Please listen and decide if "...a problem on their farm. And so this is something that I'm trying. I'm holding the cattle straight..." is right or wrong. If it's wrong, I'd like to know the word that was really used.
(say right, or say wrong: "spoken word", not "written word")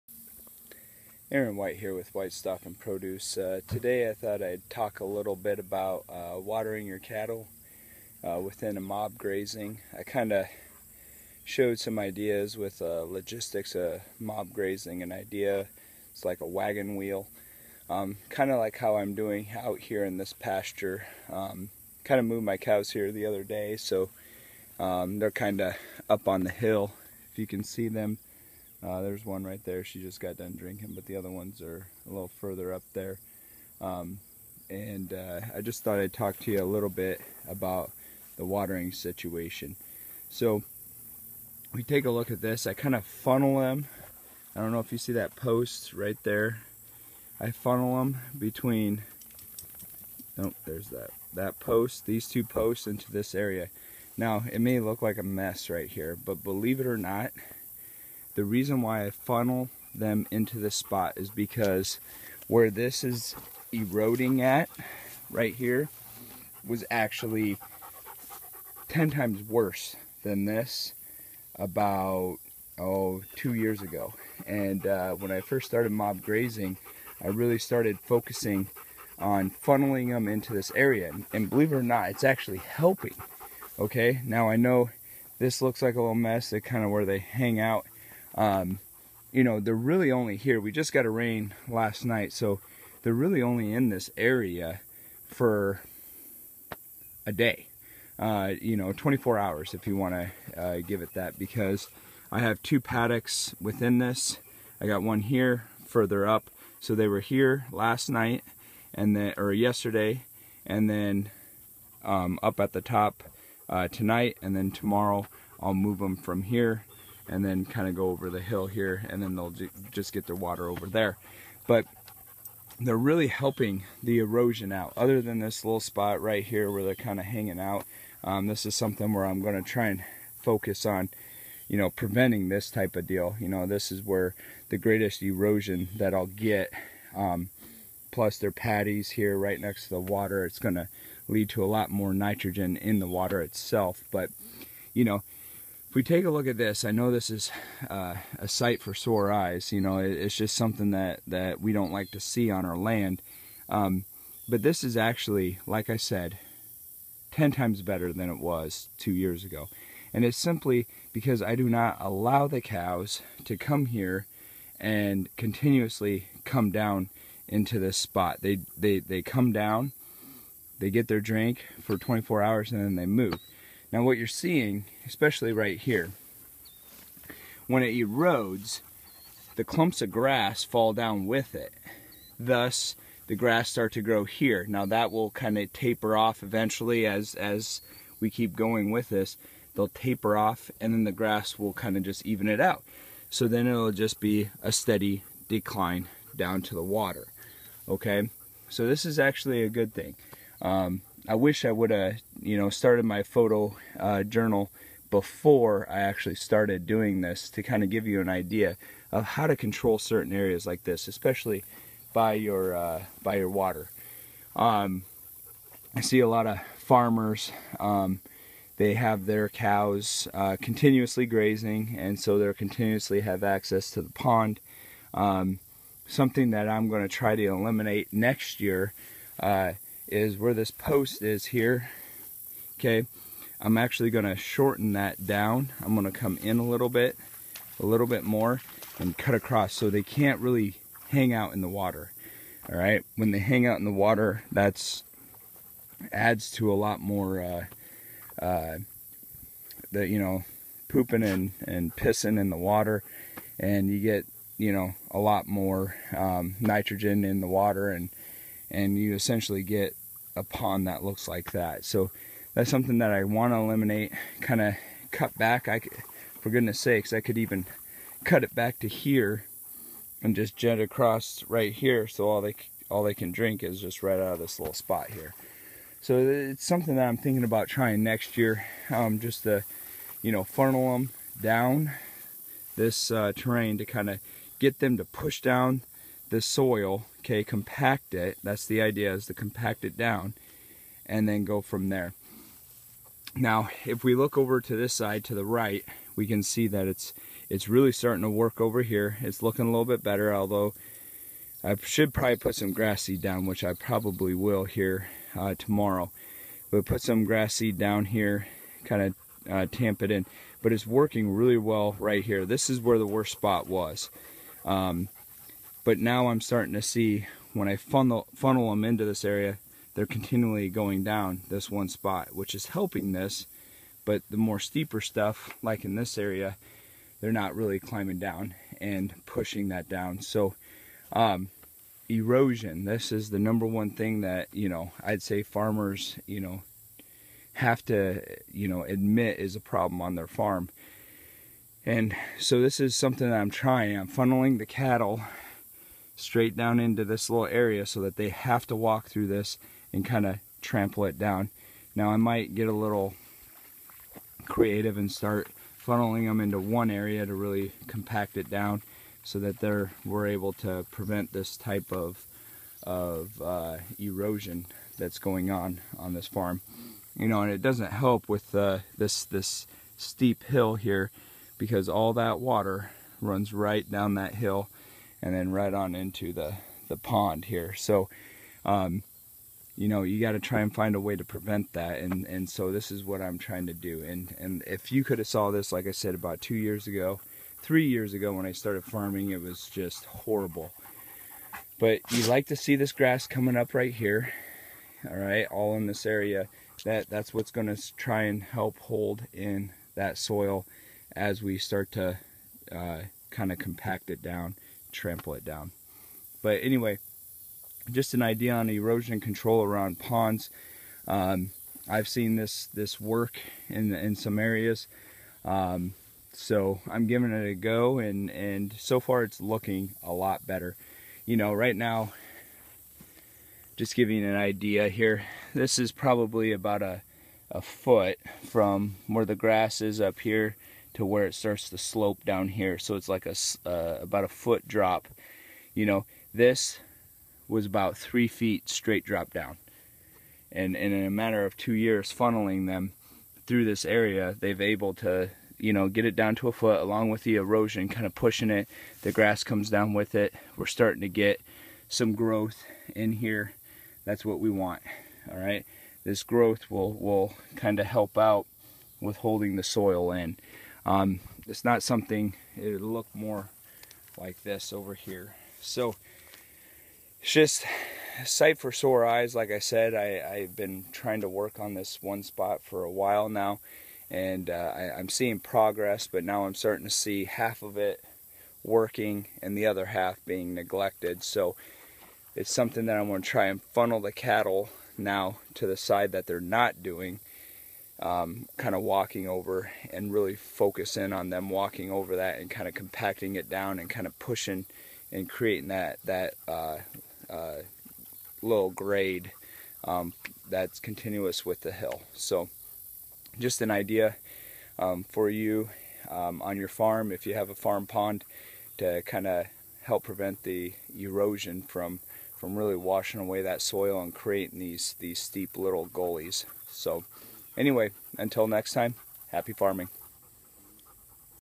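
wrong: "funneling", not "holding".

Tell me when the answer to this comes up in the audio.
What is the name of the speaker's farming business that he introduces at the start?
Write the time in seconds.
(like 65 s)
2 s.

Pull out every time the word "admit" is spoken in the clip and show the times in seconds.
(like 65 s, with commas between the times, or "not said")
338 s.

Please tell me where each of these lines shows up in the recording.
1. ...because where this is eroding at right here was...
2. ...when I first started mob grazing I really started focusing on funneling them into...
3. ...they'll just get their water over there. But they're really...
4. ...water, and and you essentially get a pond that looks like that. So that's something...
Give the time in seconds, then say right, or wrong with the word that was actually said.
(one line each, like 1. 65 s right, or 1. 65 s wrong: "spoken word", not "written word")
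1. 61 s right
2. 75 s right
3. 119 s right
4. 257 s right.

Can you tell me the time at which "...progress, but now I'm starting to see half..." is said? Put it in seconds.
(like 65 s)
475 s.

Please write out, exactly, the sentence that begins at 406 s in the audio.
But anyway, just an idea on erosion control around ponds.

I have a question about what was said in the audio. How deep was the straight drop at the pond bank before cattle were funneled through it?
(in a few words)
three feet.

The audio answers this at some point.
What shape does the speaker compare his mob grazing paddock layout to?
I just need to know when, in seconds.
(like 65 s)
16 s.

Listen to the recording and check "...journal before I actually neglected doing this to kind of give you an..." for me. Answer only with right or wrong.
wrong.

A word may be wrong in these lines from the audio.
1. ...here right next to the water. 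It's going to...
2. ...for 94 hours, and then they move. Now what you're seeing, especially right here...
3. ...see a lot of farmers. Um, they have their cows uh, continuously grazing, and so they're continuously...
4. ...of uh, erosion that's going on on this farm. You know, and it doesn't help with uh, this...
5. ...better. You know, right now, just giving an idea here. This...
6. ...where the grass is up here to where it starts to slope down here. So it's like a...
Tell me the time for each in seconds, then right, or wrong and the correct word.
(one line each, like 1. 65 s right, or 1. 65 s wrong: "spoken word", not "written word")
1. 139 s right
2. 171 s wrong: "24", not "94"
3. 216 s right
4. 362 s right
5. 420 s right
6. 429 s right.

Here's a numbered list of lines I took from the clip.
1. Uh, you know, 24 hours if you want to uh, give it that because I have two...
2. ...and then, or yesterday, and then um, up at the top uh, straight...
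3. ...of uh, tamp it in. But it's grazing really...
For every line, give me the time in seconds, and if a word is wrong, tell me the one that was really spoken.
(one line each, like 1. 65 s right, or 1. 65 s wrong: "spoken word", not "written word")
1. 98 s right
2. 108 s wrong: "tonight", not "straight"
3. 309 s wrong: "working", not "grazing".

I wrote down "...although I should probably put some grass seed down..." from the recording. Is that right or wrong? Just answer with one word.
right.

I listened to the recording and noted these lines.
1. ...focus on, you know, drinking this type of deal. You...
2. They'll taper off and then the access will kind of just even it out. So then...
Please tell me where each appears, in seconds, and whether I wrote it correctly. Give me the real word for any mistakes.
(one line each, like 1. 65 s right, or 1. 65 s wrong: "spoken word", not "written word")
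1. 130 s wrong: "preventing", not "drinking"
2. 189 s wrong: "grass", not "access".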